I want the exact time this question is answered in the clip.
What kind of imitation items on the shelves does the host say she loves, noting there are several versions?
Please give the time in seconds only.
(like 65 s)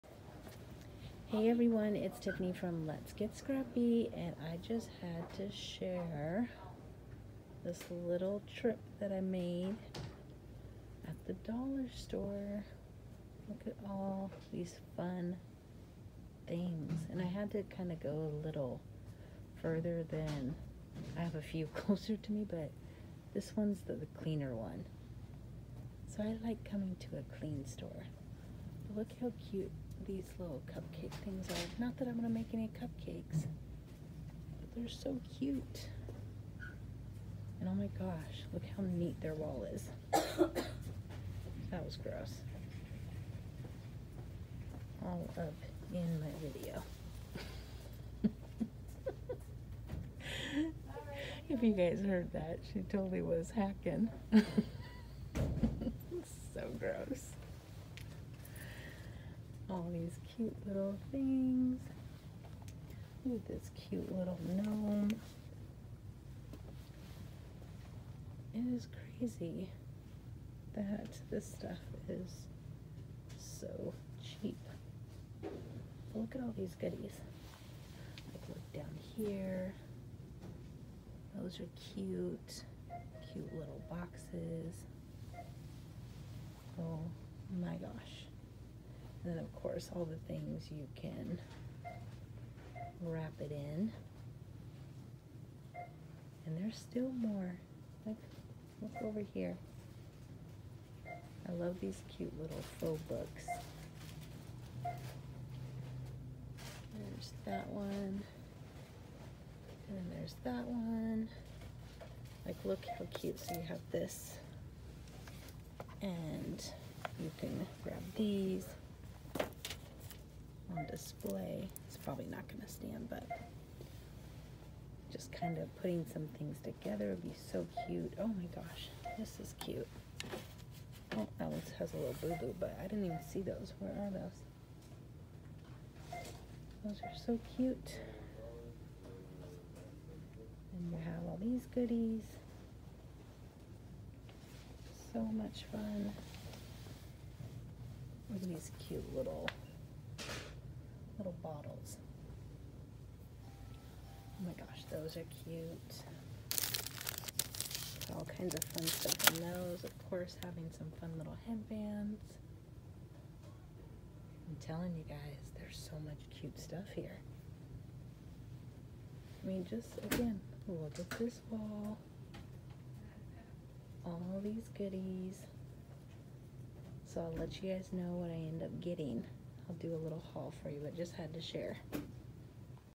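102 s.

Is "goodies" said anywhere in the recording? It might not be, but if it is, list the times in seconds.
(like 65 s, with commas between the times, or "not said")
76 s, 141 s, 174 s.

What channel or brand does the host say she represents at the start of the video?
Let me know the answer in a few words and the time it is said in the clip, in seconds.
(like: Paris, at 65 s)
Let's Get Scrappy, at 2 s.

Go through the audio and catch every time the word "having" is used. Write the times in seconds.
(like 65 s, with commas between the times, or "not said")
160 s.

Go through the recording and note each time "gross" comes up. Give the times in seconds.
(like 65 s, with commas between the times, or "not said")
42 s, 56 s.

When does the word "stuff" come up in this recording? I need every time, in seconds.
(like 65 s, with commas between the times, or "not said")
71 s, 158 s, 166 s.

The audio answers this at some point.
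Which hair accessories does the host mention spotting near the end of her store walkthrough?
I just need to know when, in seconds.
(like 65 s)
161 s.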